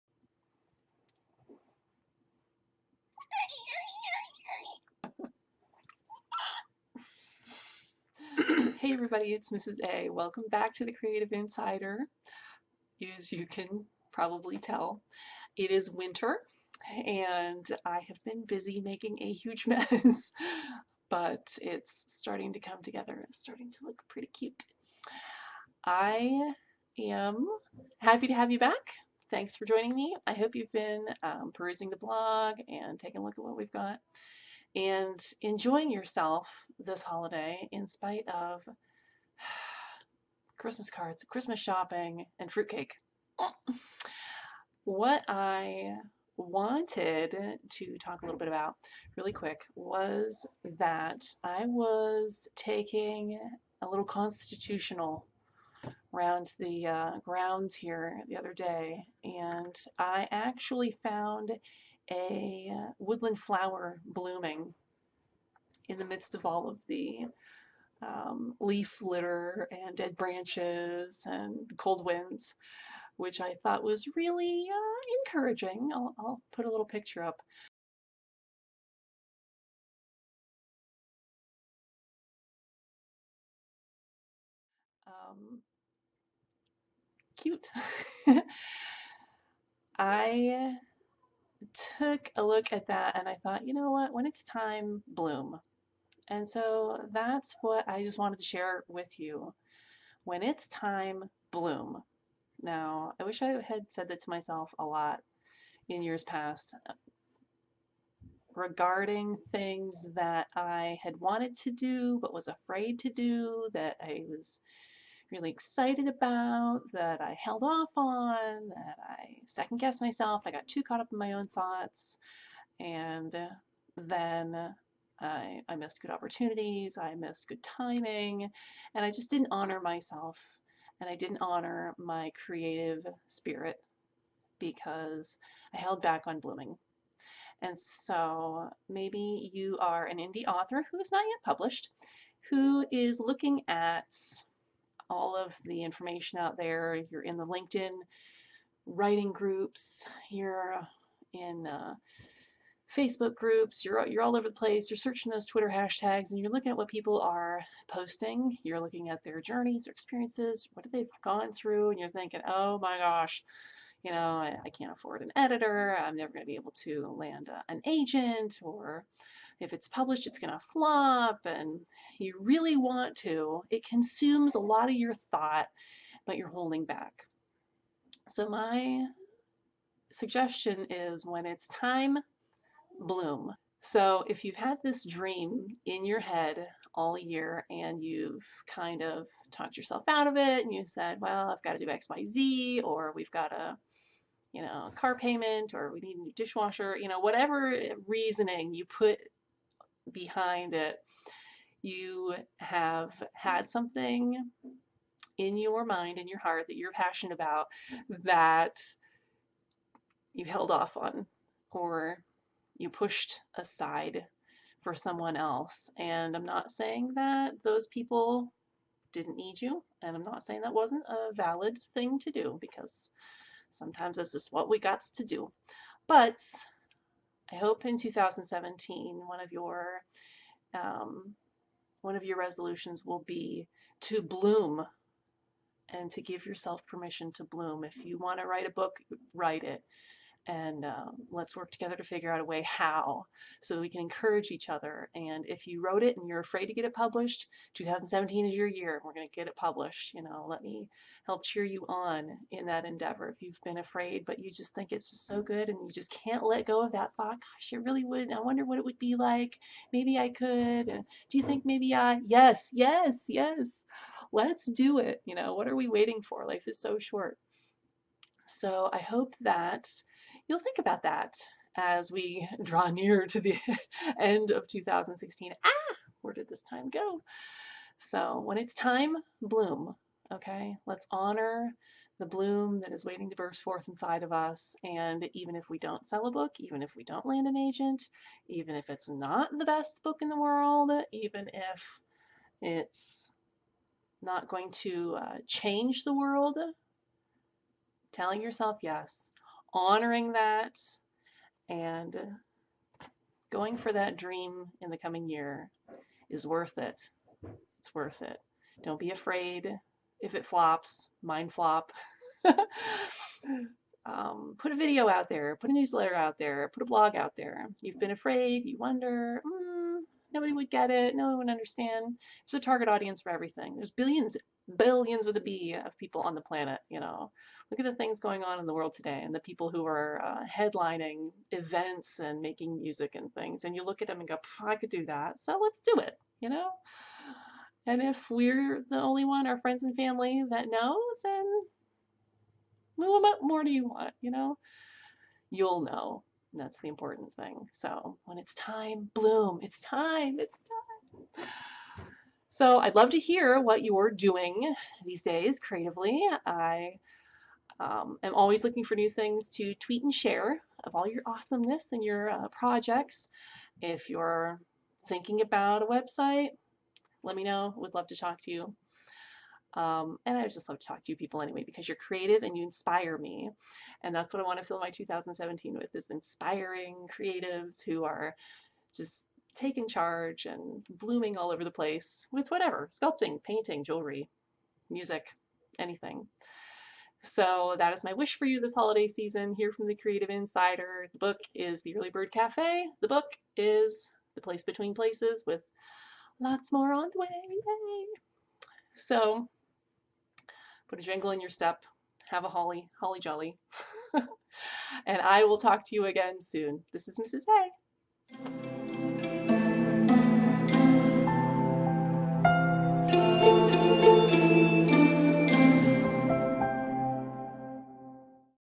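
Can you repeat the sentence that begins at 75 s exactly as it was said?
I'll, I'll put a little picture up.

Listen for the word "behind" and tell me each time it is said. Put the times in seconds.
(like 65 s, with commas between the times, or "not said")
200 s.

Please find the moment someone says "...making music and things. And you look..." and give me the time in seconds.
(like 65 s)
332 s.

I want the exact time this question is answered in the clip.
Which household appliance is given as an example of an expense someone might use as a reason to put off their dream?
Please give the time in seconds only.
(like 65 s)
196 s.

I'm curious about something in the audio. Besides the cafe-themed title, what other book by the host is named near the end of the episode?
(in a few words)
The Place Between Places.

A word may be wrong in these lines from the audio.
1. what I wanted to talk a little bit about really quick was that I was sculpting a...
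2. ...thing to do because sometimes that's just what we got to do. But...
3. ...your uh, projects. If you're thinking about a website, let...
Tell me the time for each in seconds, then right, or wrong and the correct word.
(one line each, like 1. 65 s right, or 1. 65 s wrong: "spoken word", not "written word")
1. 44 s wrong: "taking", not "sculpting"
2. 221 s right
3. 362 s right.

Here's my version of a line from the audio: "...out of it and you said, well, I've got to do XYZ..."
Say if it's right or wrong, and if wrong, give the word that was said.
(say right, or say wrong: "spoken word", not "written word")
right.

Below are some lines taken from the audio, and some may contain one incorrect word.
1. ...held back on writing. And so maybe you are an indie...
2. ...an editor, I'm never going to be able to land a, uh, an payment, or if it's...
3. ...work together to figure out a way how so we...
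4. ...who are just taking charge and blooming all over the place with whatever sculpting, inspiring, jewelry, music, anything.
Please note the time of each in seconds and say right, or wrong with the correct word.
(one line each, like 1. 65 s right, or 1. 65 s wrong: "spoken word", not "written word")
1. 135 s wrong: "blooming", not "writing"
2. 165 s wrong: "agent", not "payment"
3. 241 s right
4. 377 s wrong: "painting", not "inspiring".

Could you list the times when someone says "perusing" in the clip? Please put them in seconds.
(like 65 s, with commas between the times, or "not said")
31 s.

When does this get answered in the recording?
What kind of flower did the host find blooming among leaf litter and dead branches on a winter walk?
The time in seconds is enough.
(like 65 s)
62 s.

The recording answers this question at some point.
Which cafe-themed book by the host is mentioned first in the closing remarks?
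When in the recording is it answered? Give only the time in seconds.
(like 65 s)
391 s.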